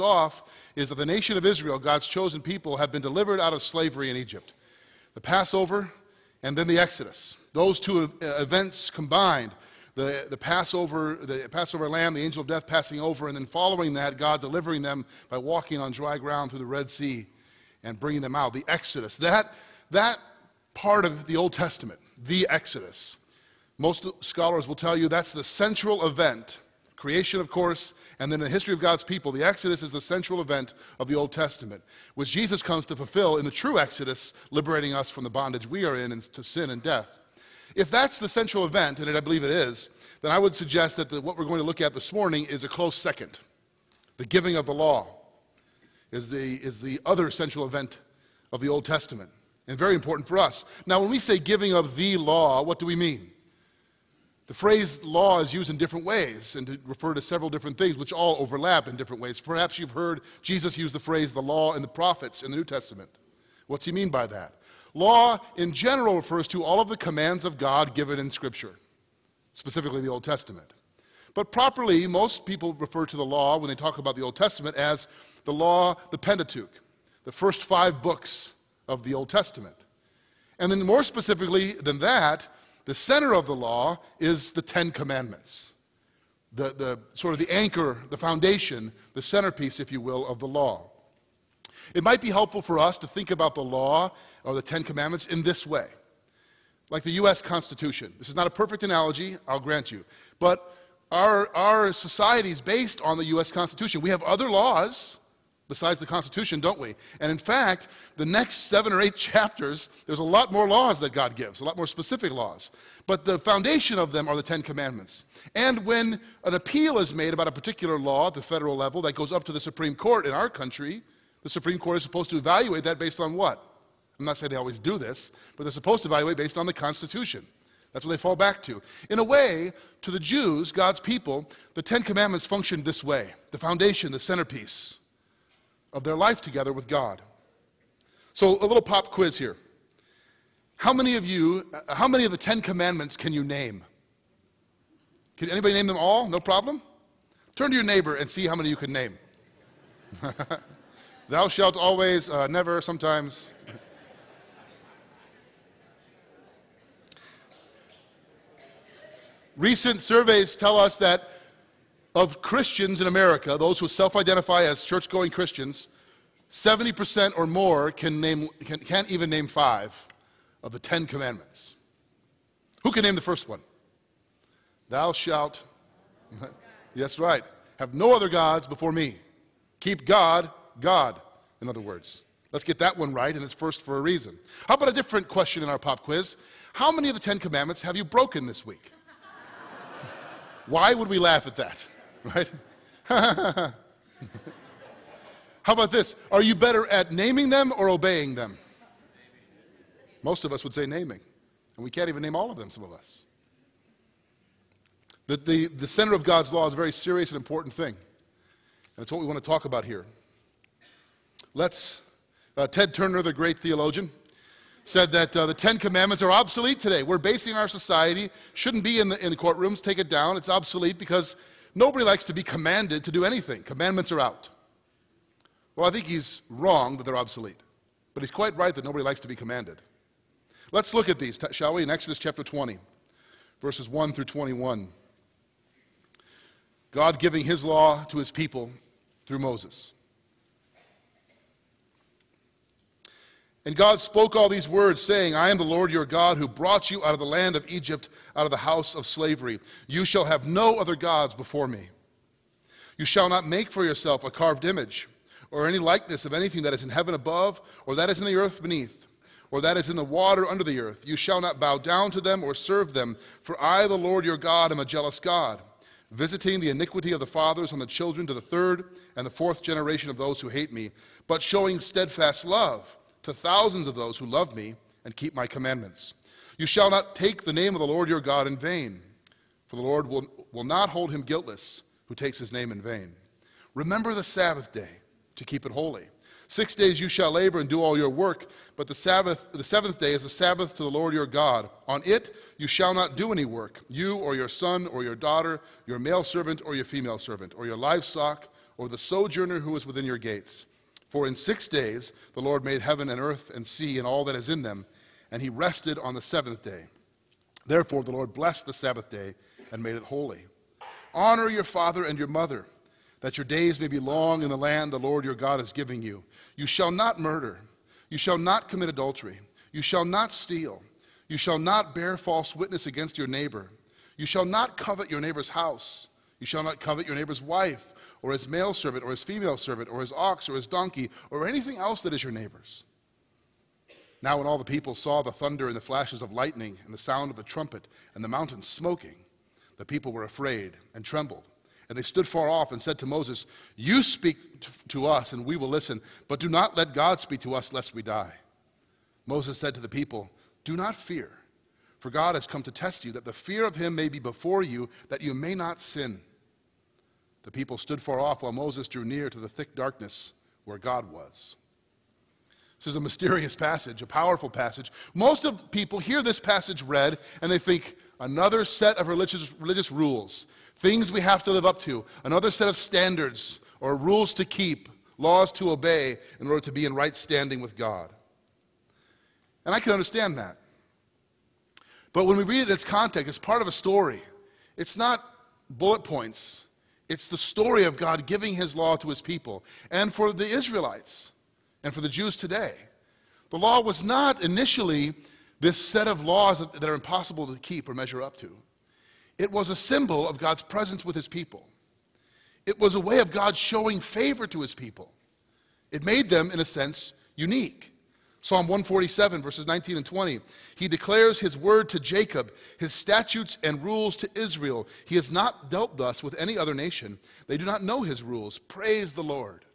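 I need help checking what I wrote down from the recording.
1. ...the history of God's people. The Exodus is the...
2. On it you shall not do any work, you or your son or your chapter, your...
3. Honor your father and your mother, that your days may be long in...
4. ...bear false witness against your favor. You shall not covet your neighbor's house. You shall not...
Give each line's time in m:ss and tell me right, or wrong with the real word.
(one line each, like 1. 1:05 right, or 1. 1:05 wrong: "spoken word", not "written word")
1. 0:28 right
2. 4:51 wrong: "daughter", not "chapter"
3. 5:11 right
4. 5:21 wrong: "neighbor", not "favor".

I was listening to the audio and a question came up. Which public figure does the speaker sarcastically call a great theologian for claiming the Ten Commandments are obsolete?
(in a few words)
Ted Turner.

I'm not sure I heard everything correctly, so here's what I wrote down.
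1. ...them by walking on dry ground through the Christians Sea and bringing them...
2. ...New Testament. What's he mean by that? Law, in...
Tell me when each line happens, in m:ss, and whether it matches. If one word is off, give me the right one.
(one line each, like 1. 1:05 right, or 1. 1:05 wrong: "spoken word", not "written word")
1. 0:14 wrong: "Red", not "Christians"
2. 1:02 right.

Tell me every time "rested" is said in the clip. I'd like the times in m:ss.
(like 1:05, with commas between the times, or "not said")
5:05.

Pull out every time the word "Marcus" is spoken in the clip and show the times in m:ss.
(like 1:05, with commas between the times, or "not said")
not said.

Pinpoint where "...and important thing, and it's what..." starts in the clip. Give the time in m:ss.
3:27.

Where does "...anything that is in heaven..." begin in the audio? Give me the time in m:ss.
4:16.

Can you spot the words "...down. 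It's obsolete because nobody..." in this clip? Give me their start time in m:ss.
3:40.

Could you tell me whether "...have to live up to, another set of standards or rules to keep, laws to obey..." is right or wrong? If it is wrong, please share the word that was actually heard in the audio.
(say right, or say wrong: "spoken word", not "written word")
right.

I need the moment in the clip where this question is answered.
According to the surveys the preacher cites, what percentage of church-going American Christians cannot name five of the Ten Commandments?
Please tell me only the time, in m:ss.
2:46.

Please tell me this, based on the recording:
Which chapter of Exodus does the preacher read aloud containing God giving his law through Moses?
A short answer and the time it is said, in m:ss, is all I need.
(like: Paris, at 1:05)
Chapter 20, at 3:52.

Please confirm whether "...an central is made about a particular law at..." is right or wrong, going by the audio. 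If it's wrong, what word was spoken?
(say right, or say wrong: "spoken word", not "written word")
wrong: "appeal", not "central".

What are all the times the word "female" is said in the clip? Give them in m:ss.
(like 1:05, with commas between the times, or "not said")
4:56, 5:29.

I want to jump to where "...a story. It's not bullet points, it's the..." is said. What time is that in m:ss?
6:23.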